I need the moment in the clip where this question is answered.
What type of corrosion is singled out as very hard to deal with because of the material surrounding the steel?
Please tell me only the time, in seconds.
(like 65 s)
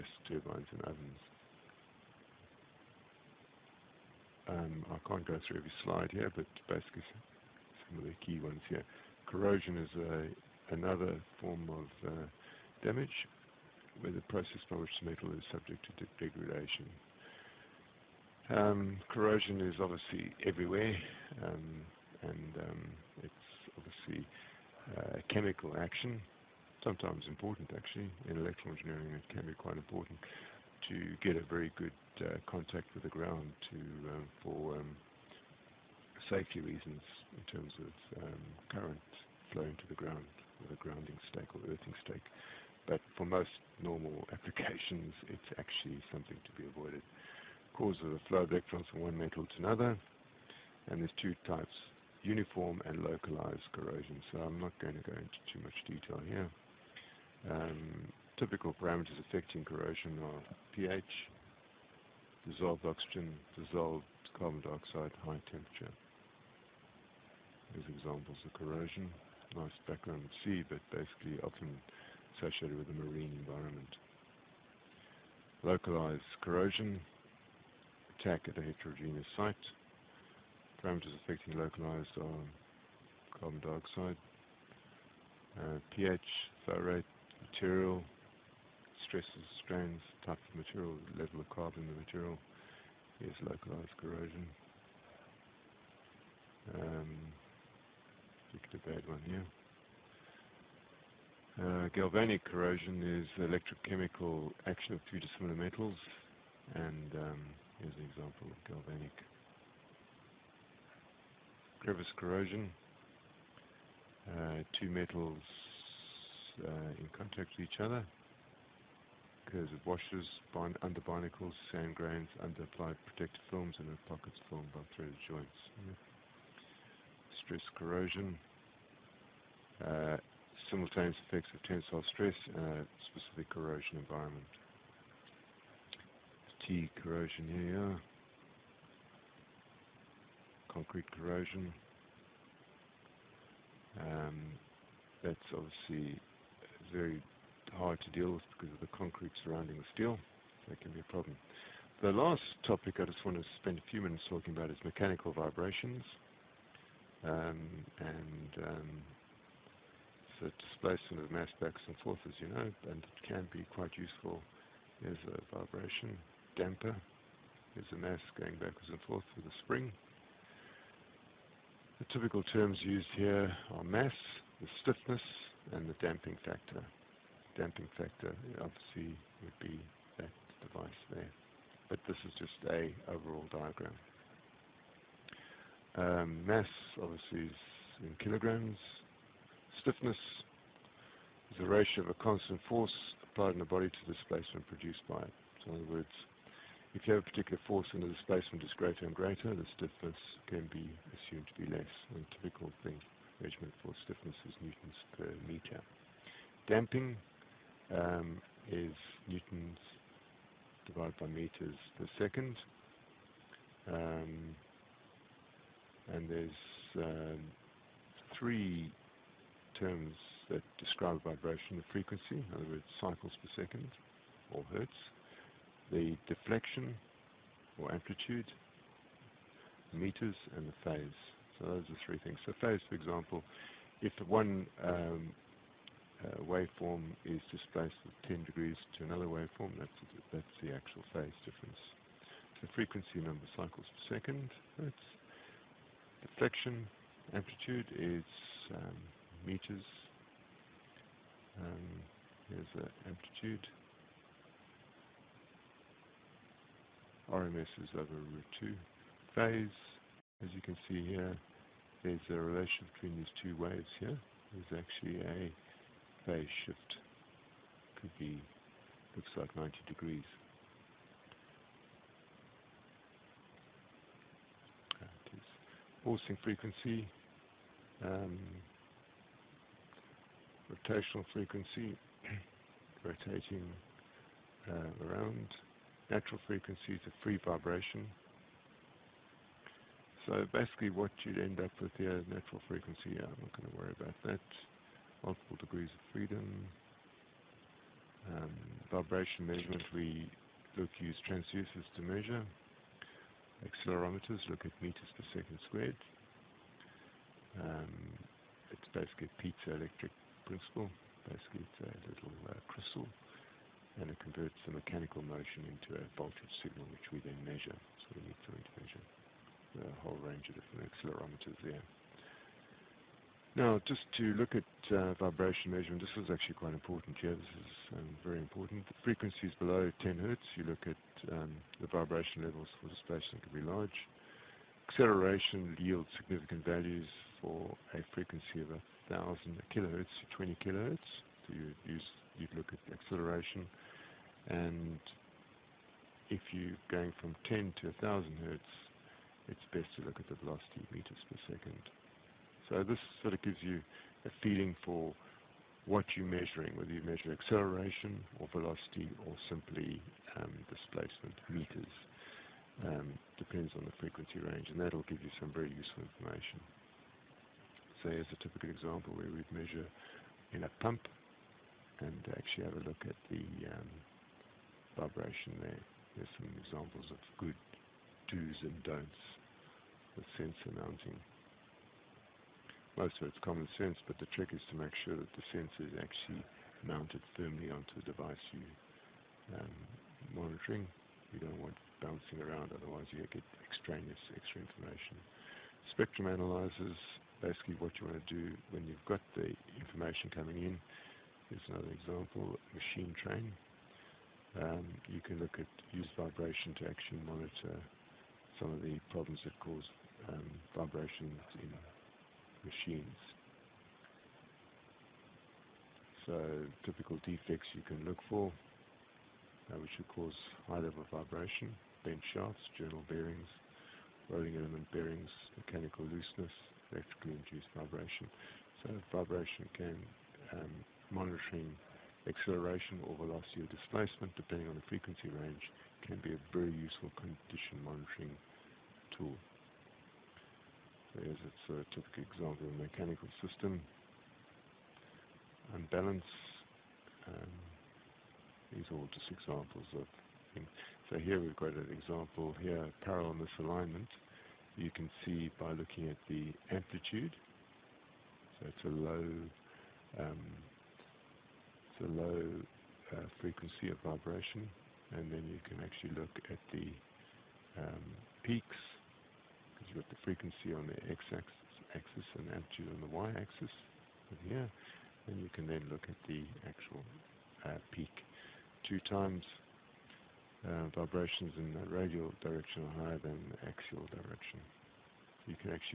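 140 s.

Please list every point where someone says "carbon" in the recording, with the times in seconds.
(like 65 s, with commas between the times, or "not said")
64 s, 83 s, 91 s.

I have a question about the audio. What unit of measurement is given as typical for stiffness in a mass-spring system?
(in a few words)
newtons per meter.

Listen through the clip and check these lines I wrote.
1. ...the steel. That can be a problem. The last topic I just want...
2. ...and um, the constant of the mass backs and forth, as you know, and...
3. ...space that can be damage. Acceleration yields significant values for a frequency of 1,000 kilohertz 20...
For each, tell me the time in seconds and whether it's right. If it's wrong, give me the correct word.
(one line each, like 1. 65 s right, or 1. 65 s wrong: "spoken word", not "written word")
1. 149 s right
2. 157 s wrong: "displacement", not "constant"
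3. 332 s wrong: "large", not "damage".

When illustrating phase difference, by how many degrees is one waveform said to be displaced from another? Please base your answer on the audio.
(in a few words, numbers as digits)
10 degrees.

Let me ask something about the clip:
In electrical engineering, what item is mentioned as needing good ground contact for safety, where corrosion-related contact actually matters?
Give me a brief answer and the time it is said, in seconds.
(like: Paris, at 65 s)
grounding stake, at 40 s.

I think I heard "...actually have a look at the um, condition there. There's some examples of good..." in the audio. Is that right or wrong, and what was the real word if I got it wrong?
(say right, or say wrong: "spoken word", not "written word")
wrong: "vibration", not "condition".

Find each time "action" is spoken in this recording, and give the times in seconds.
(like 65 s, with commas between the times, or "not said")
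25 s, 104 s.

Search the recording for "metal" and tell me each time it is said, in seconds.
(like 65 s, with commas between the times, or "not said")
15 s, 49 s, 105 s, 114 s.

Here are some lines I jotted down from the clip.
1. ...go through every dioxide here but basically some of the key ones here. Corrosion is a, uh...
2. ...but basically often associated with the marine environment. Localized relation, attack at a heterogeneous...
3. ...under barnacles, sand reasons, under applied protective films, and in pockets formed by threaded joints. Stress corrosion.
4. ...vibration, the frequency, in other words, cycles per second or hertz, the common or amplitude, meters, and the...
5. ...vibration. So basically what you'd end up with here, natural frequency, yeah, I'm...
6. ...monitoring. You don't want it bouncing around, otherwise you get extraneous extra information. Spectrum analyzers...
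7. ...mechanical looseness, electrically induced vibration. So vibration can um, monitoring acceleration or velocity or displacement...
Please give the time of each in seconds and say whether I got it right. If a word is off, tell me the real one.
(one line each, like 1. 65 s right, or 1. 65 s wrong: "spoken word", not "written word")
1. 5 s wrong: "slide", not "dioxide"
2. 70 s wrong: "corrosion", not "relation"
3. 120 s wrong: "grains", not "reasons"
4. 221 s wrong: "deflection", not "common"
5. 287 s right
6. 390 s right
7. 425 s right.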